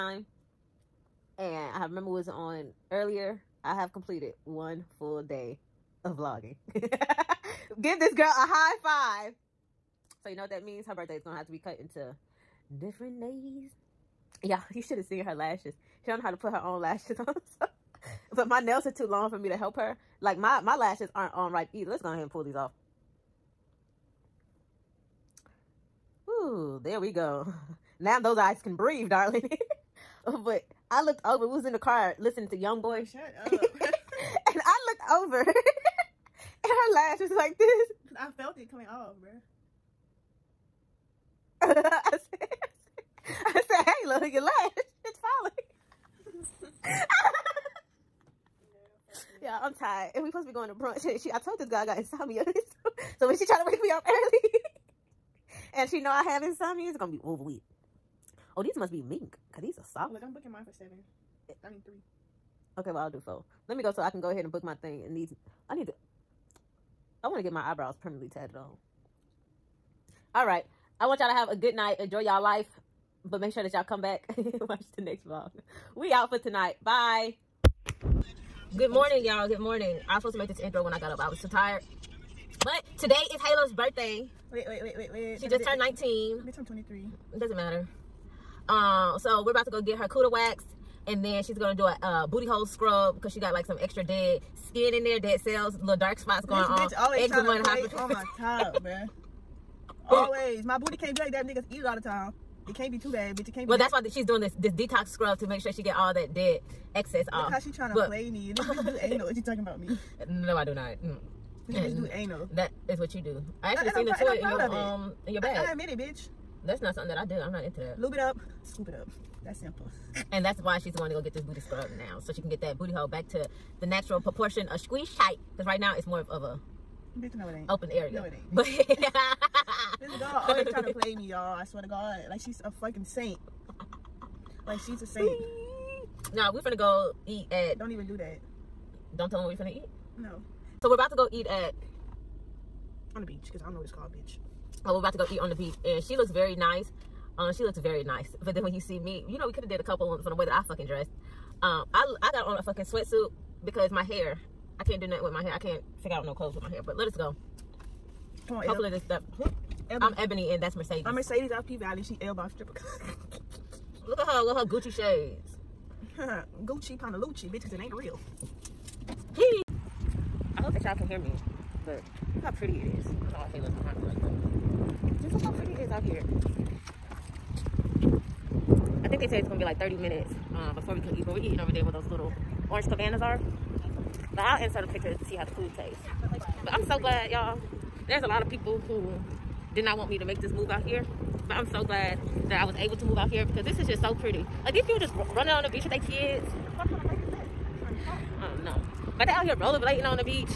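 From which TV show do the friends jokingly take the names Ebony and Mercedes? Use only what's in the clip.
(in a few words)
P Valley.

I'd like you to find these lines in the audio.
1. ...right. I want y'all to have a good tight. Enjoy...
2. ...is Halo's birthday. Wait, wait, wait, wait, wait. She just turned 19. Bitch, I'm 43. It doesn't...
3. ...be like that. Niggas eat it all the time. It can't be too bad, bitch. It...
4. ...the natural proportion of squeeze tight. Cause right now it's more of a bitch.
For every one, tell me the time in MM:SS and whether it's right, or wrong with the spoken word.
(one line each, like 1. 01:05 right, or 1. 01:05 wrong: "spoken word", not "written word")
1. 01:10 wrong: "night", not "tight"
2. 01:23 wrong: "23", not "43"
3. 01:41 right
4. 02:03 right.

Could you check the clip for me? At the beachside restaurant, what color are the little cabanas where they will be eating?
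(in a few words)
Orange.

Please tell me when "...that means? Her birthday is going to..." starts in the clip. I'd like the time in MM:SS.
00:10.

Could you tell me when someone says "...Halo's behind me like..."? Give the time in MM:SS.
02:53.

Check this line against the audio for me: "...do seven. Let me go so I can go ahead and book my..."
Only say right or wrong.
wrong.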